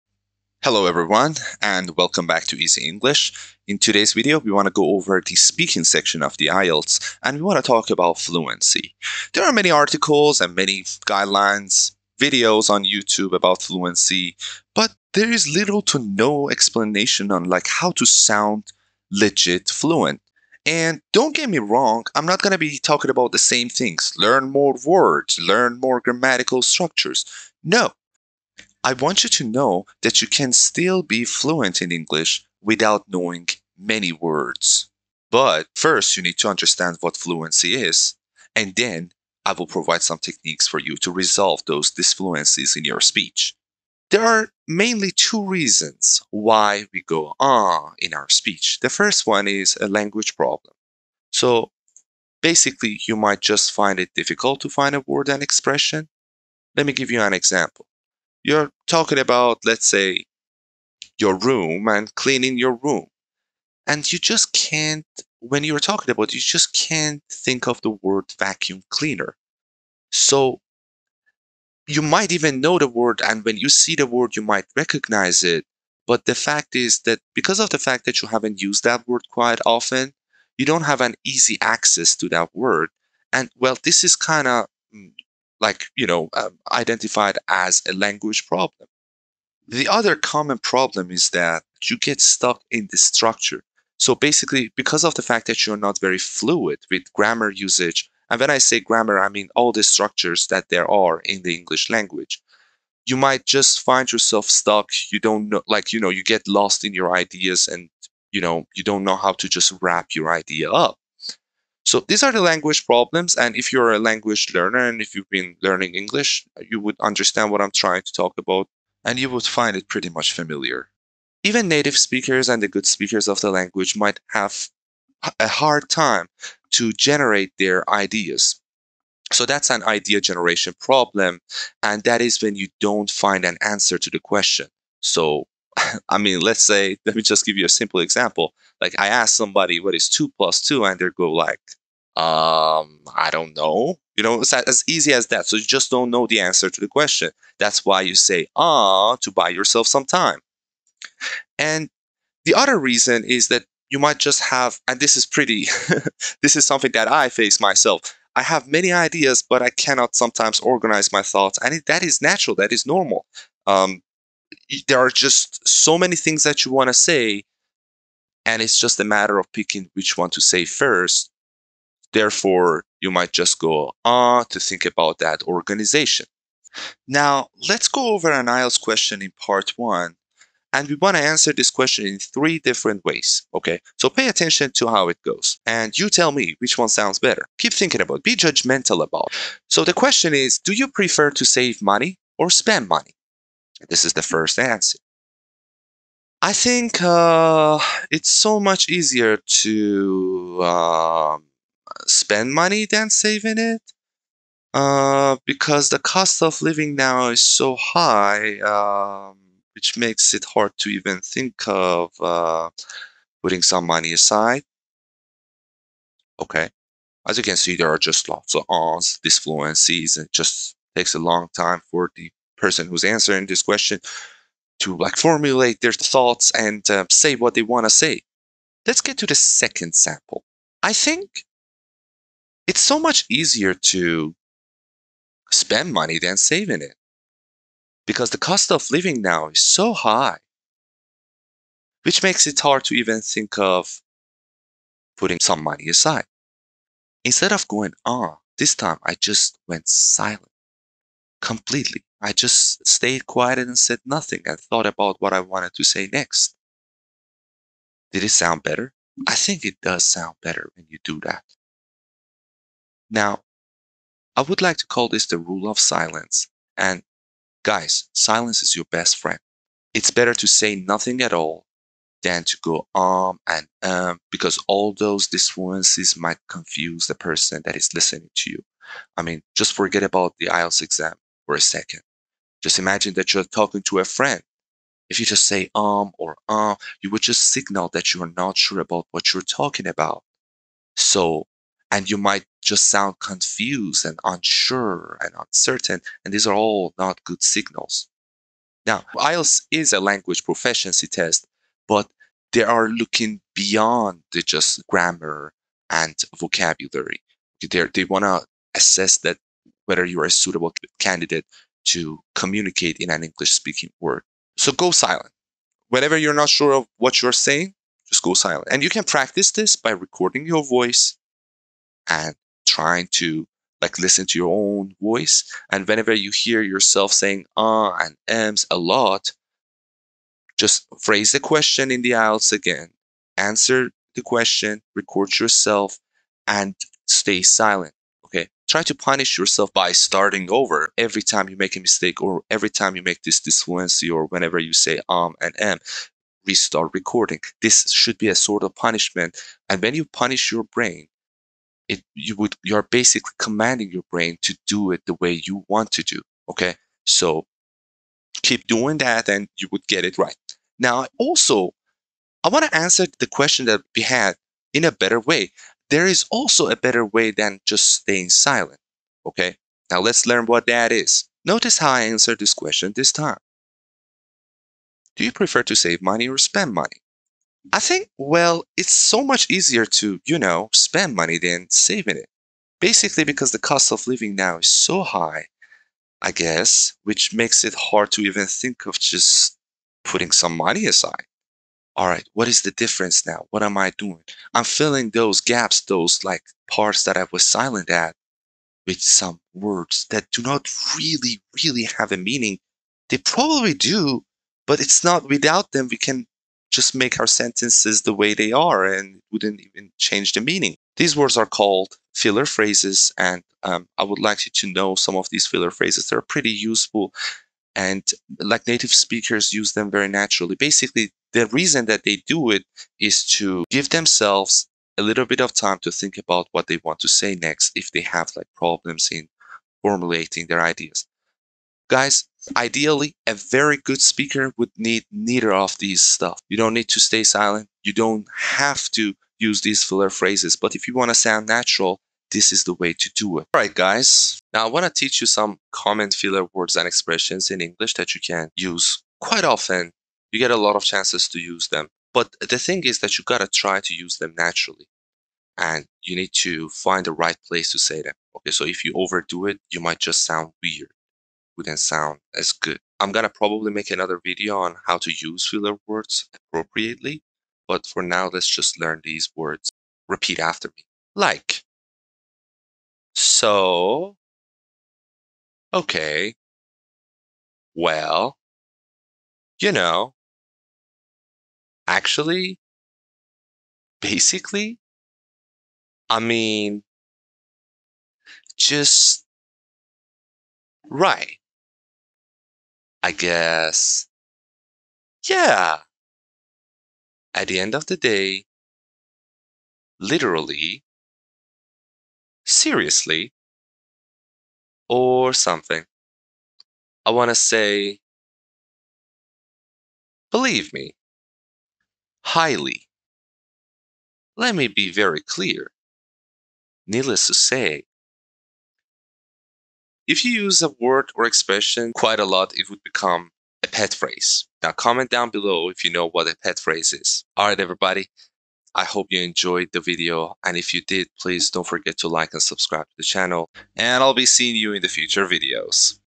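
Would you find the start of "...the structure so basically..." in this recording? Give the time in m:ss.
1:32.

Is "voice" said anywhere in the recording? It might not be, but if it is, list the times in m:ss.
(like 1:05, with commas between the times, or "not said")
5:20, 5:25.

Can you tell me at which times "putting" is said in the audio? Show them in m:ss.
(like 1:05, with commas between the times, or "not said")
3:33, 4:05, 6:30.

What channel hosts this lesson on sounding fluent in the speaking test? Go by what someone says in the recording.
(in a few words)
Easy English.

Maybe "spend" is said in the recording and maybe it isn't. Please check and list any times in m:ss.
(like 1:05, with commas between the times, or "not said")
3:12, 3:22, 3:55, 6:16, 6:20.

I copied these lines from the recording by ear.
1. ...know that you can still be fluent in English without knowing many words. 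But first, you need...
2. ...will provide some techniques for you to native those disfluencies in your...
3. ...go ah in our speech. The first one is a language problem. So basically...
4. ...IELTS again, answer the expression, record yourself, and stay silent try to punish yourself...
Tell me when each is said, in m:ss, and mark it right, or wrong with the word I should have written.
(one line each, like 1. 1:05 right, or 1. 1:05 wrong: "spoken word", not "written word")
1. 0:29 right
2. 0:39 wrong: "resolve", not "native"
3. 0:47 right
4. 5:32 wrong: "question", not "expression".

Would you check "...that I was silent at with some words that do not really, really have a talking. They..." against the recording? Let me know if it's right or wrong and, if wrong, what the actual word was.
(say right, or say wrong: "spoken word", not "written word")
wrong: "meaning", not "talking".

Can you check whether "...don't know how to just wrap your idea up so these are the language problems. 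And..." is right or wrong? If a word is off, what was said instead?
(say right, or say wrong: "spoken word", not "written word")
right.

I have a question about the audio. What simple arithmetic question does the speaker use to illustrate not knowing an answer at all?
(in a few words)
two plus two.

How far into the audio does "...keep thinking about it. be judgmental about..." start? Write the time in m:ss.
3:07.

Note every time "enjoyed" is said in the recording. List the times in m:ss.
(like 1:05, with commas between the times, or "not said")
8:49.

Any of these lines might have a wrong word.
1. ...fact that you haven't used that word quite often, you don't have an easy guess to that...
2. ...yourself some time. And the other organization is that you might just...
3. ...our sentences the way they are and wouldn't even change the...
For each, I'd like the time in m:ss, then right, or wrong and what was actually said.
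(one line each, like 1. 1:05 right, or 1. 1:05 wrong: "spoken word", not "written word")
1. 1:17 wrong: "access", not "guess"
2. 2:29 wrong: "reason", not "organization"
3. 6:47 right.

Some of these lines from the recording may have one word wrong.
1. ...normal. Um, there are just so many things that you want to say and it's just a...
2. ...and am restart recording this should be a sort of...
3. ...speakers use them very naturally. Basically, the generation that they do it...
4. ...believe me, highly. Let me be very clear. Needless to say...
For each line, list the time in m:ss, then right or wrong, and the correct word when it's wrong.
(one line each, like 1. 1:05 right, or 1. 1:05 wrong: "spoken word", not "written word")
1. 2:42 right
2. 5:45 right
3. 6:58 wrong: "reason", not "generation"
4. 8:30 right.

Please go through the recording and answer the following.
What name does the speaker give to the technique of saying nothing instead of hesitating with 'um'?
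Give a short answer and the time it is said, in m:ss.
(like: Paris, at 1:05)
rule of silence, at 4:25.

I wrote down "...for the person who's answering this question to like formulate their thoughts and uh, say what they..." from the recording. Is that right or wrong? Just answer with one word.
right.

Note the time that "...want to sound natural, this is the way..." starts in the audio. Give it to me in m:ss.
7:20.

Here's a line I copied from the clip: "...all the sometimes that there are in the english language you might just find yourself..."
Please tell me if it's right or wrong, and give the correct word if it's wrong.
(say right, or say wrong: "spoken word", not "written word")
wrong: "structures", not "sometimes".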